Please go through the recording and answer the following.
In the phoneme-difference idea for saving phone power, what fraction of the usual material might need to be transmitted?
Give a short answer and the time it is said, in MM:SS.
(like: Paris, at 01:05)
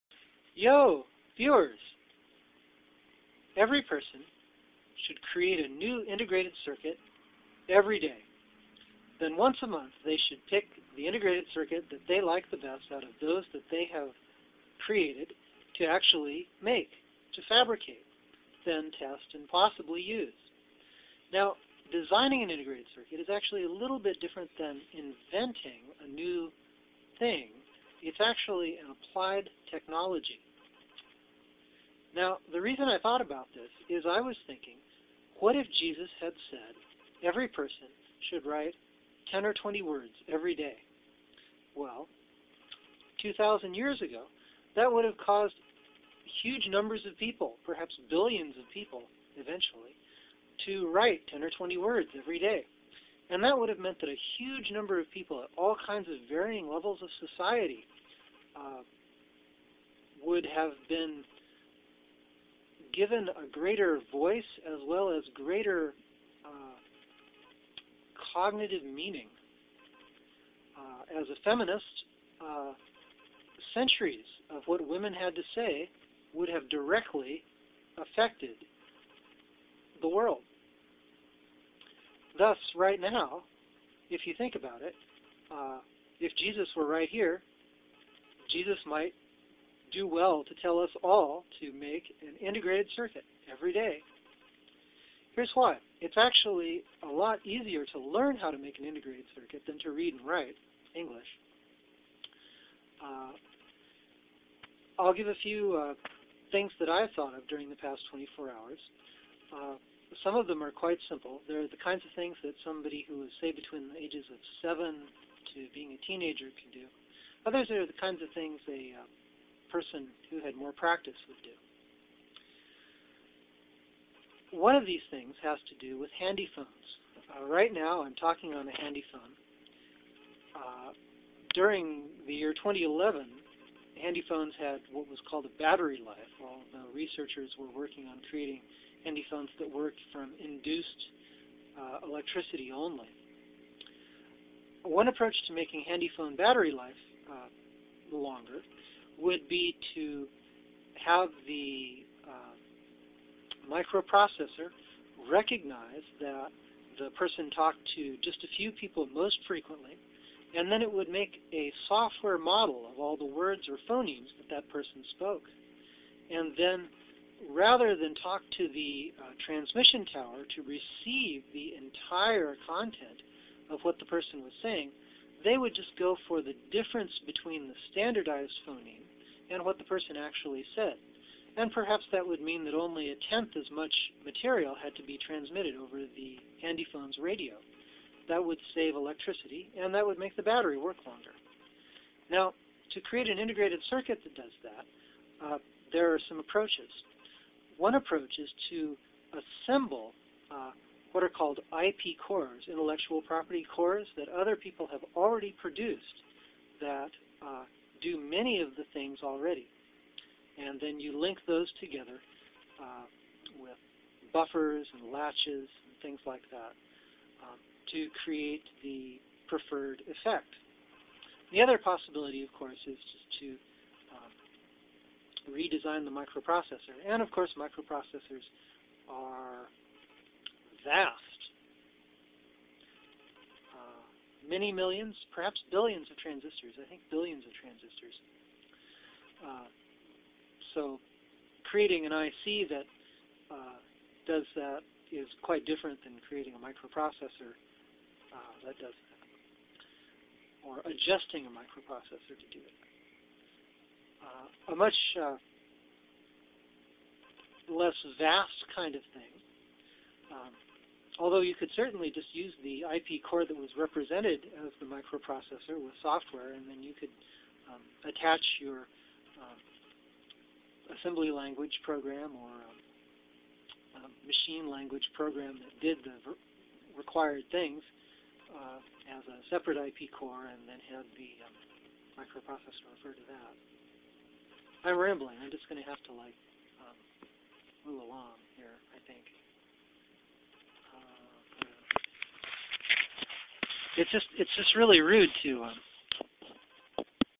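a tenth, at 03:03.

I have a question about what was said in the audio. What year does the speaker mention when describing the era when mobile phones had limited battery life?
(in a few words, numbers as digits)
2011.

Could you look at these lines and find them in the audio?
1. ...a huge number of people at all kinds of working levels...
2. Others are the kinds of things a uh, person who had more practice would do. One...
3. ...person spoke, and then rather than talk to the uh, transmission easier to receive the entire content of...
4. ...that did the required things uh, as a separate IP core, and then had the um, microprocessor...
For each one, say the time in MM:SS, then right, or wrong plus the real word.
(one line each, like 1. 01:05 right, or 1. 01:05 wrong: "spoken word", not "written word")
1. 00:54 wrong: "varying", not "working"
2. 01:57 right
3. 02:44 wrong: "tower", not "easier"
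4. 04:35 right.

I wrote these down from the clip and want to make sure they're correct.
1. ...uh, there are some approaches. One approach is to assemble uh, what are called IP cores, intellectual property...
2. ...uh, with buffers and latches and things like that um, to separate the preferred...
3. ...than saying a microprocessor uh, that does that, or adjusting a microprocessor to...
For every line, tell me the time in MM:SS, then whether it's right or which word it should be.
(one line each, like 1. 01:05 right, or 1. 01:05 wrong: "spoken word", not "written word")
1. 03:15 right
2. 03:32 wrong: "create", not "separate"
3. 04:06 wrong: "creating", not "saying".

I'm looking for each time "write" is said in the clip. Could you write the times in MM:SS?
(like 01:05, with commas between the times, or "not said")
00:38, 00:50, 01:40.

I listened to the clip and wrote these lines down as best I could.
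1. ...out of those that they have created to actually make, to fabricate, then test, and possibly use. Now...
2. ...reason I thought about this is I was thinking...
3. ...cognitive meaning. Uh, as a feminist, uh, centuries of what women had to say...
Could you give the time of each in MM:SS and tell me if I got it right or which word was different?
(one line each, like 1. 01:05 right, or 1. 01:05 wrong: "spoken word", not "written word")
1. 00:12 right
2. 00:32 right
3. 01:08 right.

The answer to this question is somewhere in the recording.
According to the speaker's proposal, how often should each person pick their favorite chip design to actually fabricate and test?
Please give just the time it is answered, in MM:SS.
00:09.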